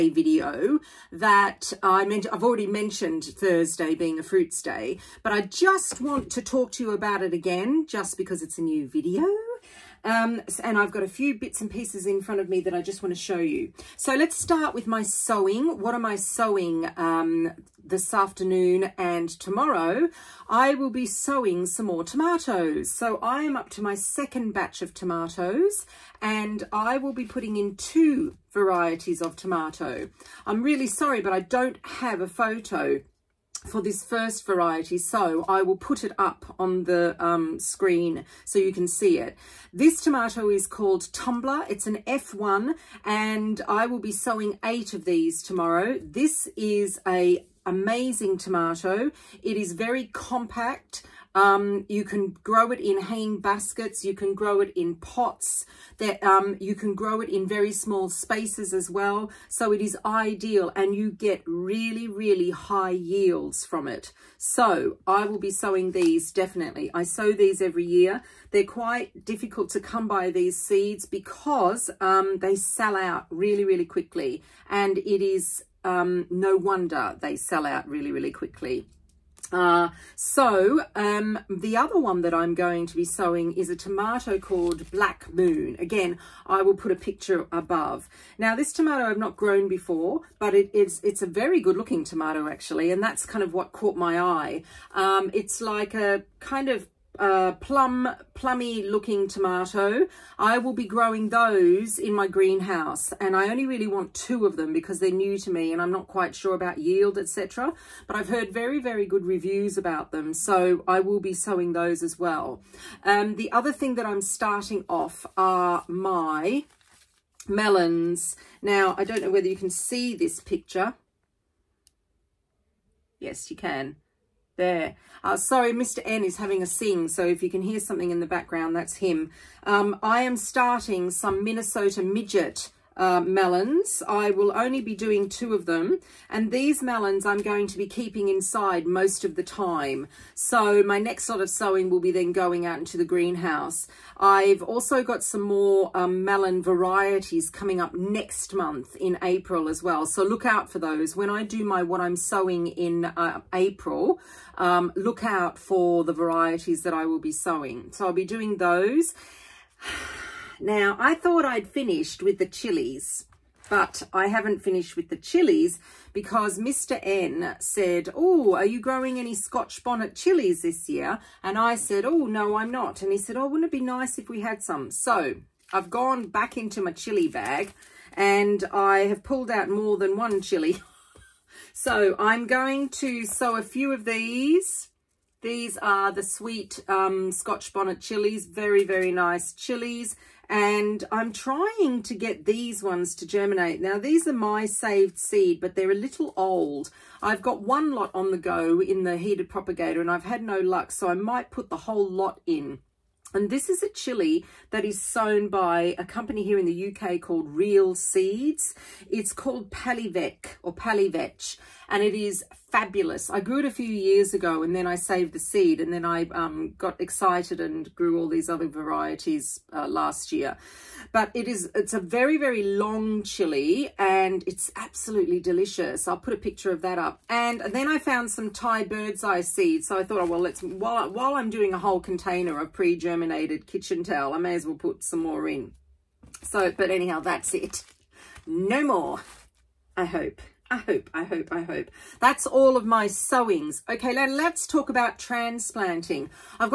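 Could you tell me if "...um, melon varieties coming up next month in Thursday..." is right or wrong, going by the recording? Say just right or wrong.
wrong.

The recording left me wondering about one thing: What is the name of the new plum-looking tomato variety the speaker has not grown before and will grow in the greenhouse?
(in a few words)
Black Moon.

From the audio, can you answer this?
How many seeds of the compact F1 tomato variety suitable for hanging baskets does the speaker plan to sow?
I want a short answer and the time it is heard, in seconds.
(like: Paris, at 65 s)
8, at 44 s.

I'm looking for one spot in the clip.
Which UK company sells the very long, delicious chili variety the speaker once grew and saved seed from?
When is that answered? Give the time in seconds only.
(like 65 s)
207 s.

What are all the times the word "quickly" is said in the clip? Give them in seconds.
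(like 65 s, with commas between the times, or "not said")
73 s, 78 s.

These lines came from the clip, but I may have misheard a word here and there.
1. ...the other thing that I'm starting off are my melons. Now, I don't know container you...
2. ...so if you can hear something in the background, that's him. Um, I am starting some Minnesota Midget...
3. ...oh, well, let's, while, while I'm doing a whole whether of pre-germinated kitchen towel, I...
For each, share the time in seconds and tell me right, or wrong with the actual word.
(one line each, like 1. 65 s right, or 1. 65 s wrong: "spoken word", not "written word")
1. 113 s wrong: "whether", not "container"
2. 127 s right
3. 230 s wrong: "container", not "whether".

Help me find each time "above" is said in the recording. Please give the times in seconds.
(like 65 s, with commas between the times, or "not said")
87 s.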